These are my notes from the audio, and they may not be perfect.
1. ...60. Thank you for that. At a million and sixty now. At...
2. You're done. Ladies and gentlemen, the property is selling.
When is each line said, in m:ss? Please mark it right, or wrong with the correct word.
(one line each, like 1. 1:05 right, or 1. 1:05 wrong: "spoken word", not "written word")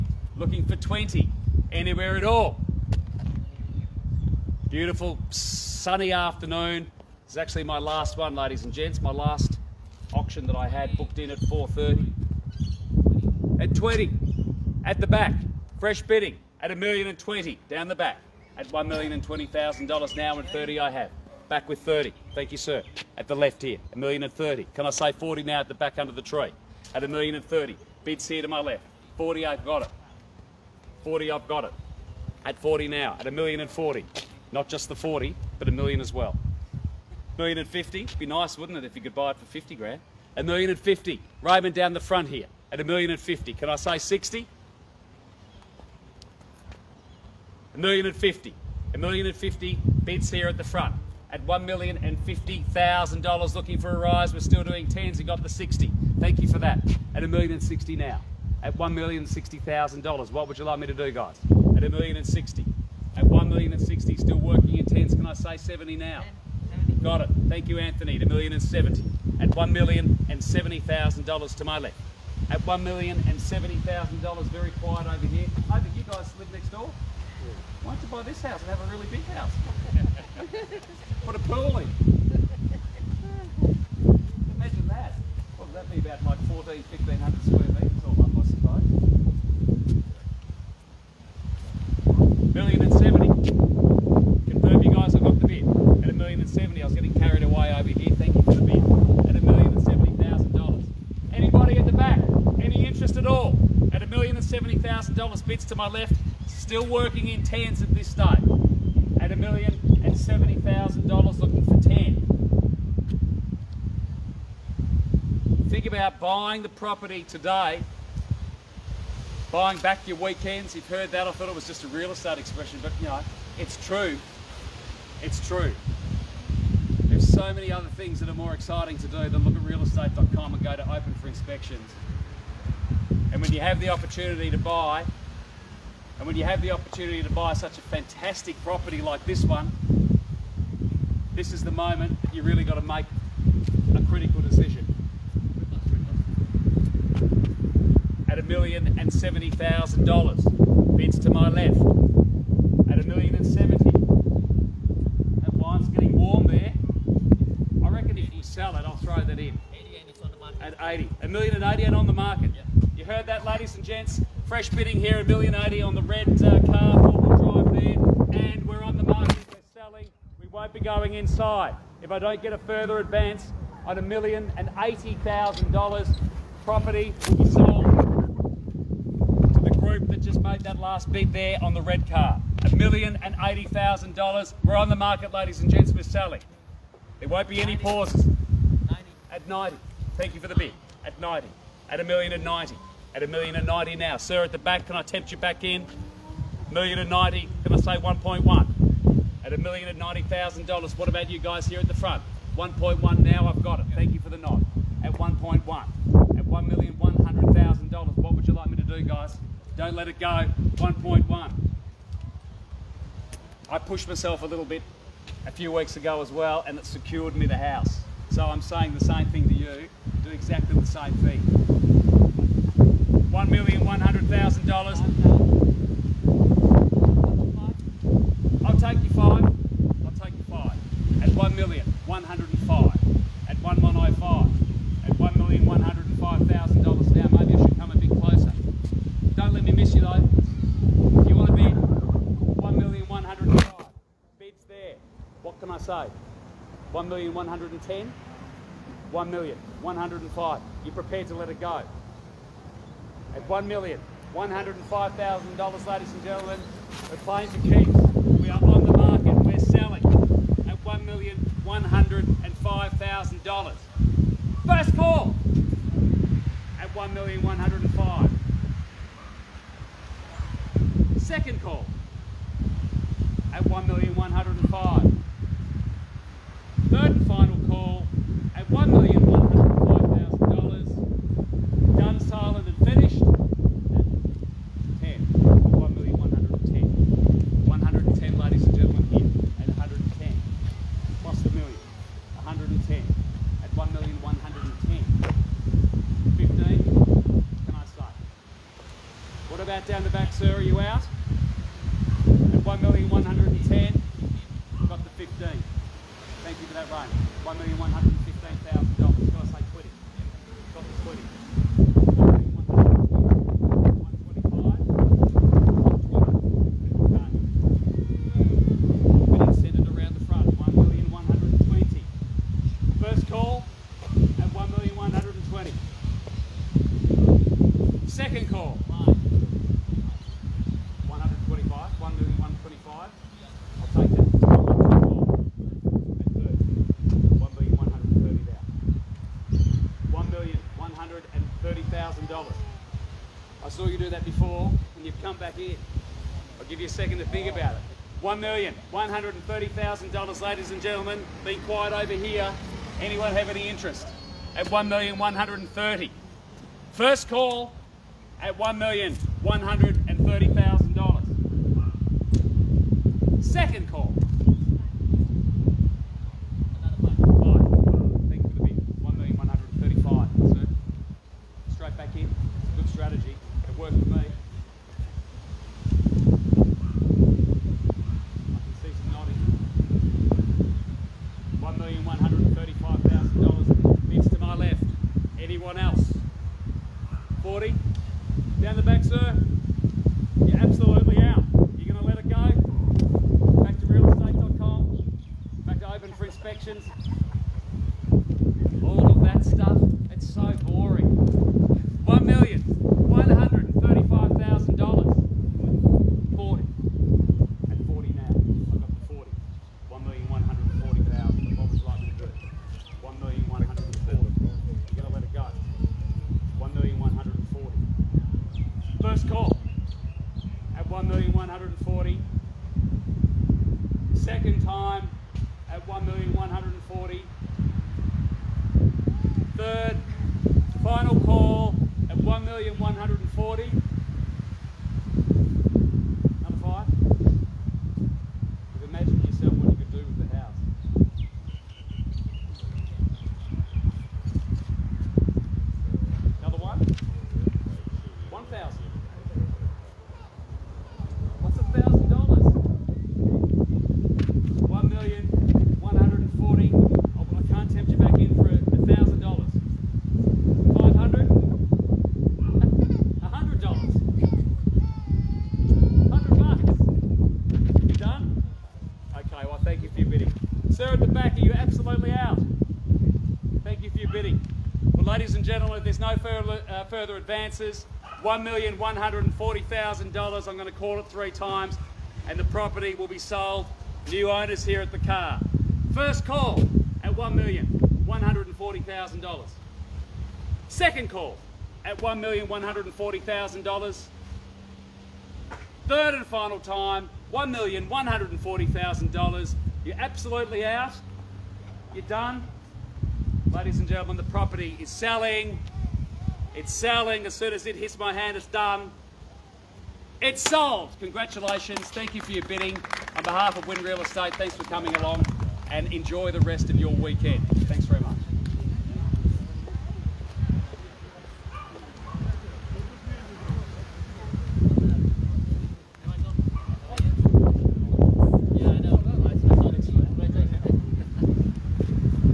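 1. 0:55 right
2. 8:21 right.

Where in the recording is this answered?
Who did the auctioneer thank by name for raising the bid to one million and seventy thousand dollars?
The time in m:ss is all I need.
1:07.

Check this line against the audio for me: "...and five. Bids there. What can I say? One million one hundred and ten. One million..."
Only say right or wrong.
right.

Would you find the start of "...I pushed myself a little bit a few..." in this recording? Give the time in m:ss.
3:33.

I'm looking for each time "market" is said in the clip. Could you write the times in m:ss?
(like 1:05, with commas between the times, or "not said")
2:42, 2:49, 3:04, 4:18.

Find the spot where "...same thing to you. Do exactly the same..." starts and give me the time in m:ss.
3:39.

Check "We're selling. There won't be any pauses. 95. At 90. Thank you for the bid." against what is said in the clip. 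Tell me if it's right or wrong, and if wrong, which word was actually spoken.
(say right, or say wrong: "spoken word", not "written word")
wrong: "90", not "95".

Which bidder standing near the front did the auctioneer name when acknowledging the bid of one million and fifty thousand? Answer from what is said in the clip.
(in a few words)
Raymond.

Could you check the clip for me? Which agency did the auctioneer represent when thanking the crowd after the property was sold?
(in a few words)
Win Real Estate.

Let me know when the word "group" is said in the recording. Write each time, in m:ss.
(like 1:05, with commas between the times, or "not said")
2:59.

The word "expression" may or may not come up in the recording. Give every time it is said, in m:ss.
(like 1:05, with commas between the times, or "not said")
2:02.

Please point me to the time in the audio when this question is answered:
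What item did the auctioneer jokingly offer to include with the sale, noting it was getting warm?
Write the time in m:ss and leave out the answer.
2:35.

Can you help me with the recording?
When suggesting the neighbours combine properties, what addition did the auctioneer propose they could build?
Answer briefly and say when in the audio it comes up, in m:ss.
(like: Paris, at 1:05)
A pool, at 1:21.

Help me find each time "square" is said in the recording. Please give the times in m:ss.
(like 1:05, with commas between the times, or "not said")
1:27.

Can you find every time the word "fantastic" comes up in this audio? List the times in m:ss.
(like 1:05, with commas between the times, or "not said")
2:17.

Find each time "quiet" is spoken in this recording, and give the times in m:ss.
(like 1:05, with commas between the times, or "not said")
1:14, 5:51.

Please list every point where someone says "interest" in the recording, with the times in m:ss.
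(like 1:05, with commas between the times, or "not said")
5:53.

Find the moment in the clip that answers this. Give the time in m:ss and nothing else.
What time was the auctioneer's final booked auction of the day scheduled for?
0:11.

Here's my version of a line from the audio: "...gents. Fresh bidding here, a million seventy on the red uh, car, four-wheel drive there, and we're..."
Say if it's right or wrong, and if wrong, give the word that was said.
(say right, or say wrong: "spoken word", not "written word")
wrong: "eighty", not "seventy".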